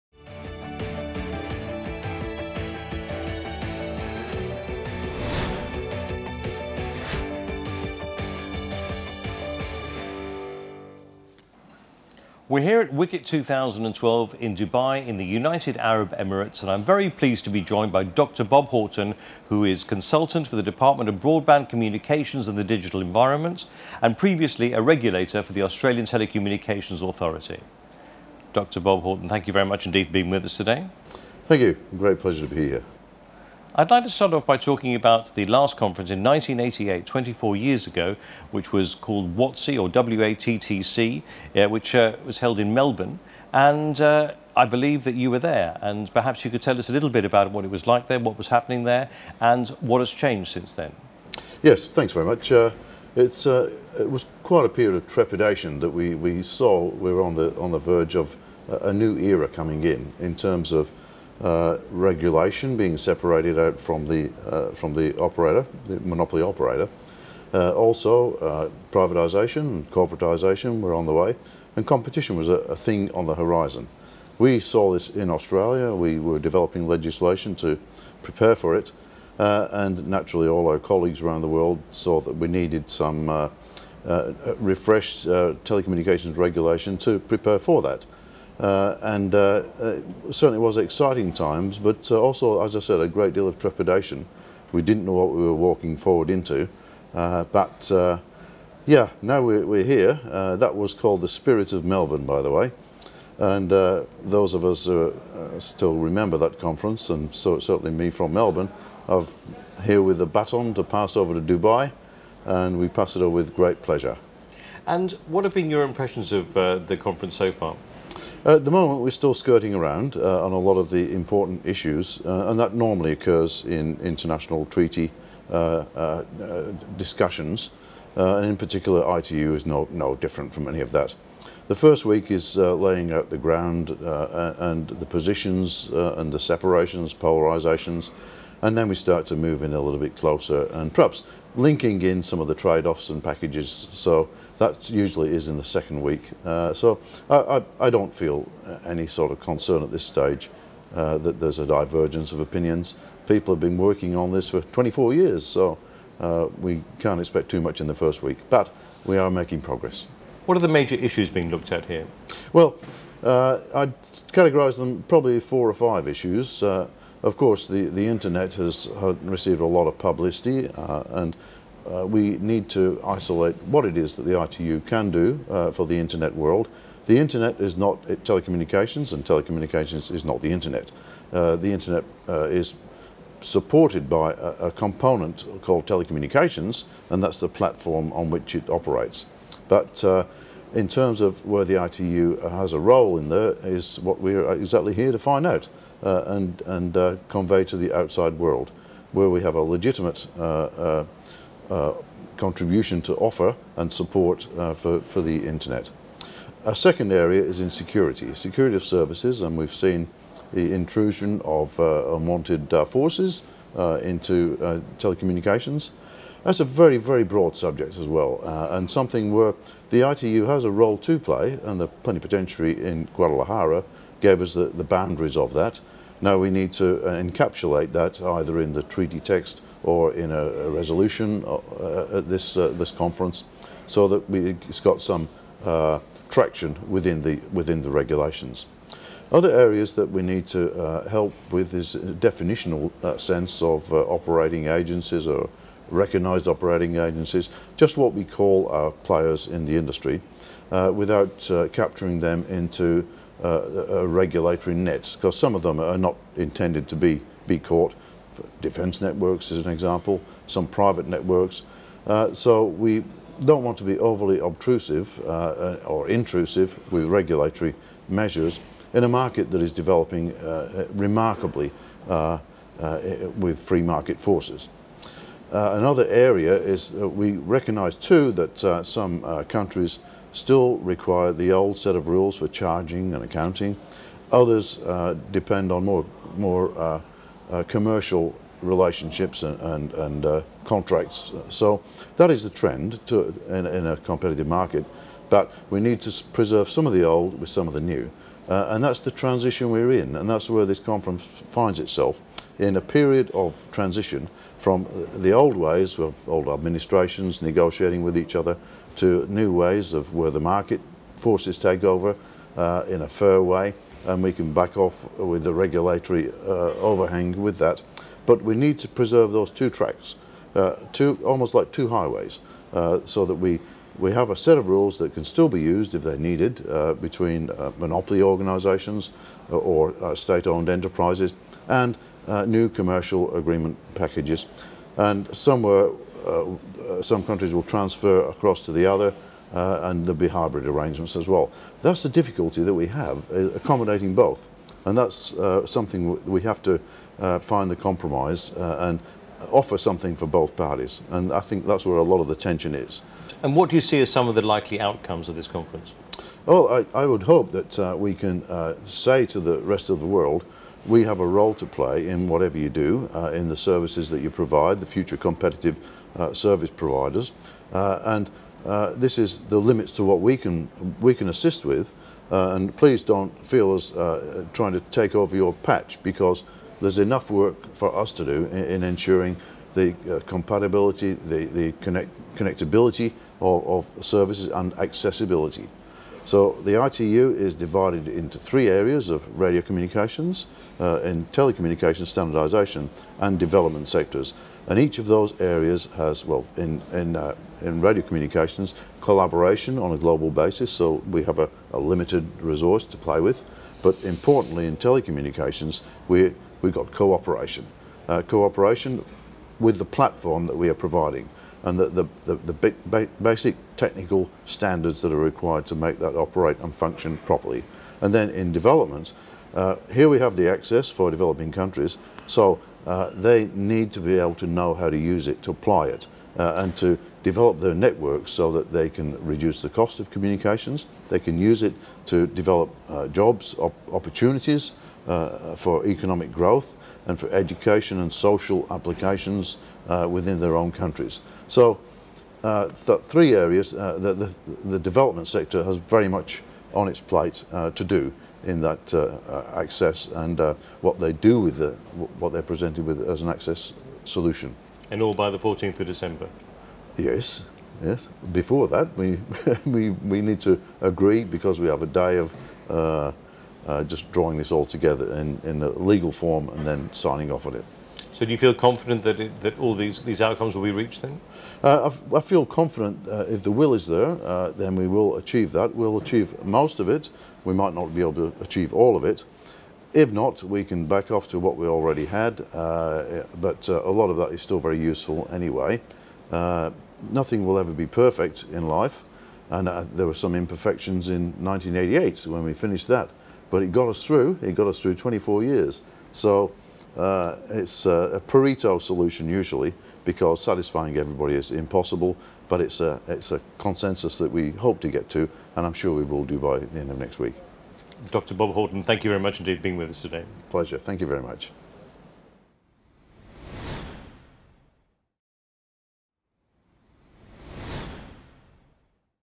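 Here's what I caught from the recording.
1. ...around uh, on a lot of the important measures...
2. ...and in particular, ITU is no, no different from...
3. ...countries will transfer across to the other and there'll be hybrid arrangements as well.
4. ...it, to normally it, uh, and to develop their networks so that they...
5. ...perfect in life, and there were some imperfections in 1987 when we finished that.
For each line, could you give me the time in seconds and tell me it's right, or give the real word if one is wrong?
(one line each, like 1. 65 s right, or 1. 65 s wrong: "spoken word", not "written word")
1. 119 s wrong: "issues", not "measures"
2. 128 s right
3. 337 s right
4. 425 s wrong: "apply", not "normally"
5. 487 s wrong: "1988", not "1987".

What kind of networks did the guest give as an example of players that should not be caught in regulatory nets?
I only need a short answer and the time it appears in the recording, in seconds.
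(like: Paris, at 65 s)
Defence networks, at 258 s.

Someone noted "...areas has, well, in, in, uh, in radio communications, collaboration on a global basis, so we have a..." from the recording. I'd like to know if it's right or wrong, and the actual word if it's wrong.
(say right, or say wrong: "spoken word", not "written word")
right.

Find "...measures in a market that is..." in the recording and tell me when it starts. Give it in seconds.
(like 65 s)
268 s.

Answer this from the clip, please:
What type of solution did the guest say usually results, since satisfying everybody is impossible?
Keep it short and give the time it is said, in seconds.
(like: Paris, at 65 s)
Pareto solution, at 498 s.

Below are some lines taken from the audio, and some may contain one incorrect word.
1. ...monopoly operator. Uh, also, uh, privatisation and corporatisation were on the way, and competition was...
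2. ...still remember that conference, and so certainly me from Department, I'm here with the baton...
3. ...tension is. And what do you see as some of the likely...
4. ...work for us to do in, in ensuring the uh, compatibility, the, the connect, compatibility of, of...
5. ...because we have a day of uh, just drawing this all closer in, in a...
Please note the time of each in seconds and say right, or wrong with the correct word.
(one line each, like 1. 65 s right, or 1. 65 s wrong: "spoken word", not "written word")
1. 66 s right
2. 105 s wrong: "Melbourne", not "Department"
3. 352 s right
4. 377 s wrong: "connectability", not "compatibility"
5. 461 s wrong: "together", not "closer".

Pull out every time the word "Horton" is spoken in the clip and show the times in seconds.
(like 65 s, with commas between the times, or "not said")
18 s, 29 s, 508 s.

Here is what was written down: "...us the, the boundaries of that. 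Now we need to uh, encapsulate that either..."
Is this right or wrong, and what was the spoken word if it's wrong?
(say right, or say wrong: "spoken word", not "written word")
right.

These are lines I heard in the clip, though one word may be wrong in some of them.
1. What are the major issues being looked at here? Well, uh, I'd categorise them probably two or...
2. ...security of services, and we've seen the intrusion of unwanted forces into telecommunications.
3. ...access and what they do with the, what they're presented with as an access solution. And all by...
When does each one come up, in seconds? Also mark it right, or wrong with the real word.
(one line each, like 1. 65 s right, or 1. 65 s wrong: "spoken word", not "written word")
1. 160 s wrong: "four", not "two"
2. 208 s right
3. 449 s right.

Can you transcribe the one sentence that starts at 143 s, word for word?
So that usually is in the second week.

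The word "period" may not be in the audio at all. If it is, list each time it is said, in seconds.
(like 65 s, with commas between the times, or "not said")
54 s, 302 s.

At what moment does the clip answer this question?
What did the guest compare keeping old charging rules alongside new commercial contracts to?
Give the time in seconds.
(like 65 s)
321 s.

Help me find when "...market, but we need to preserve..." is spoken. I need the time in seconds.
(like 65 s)
294 s.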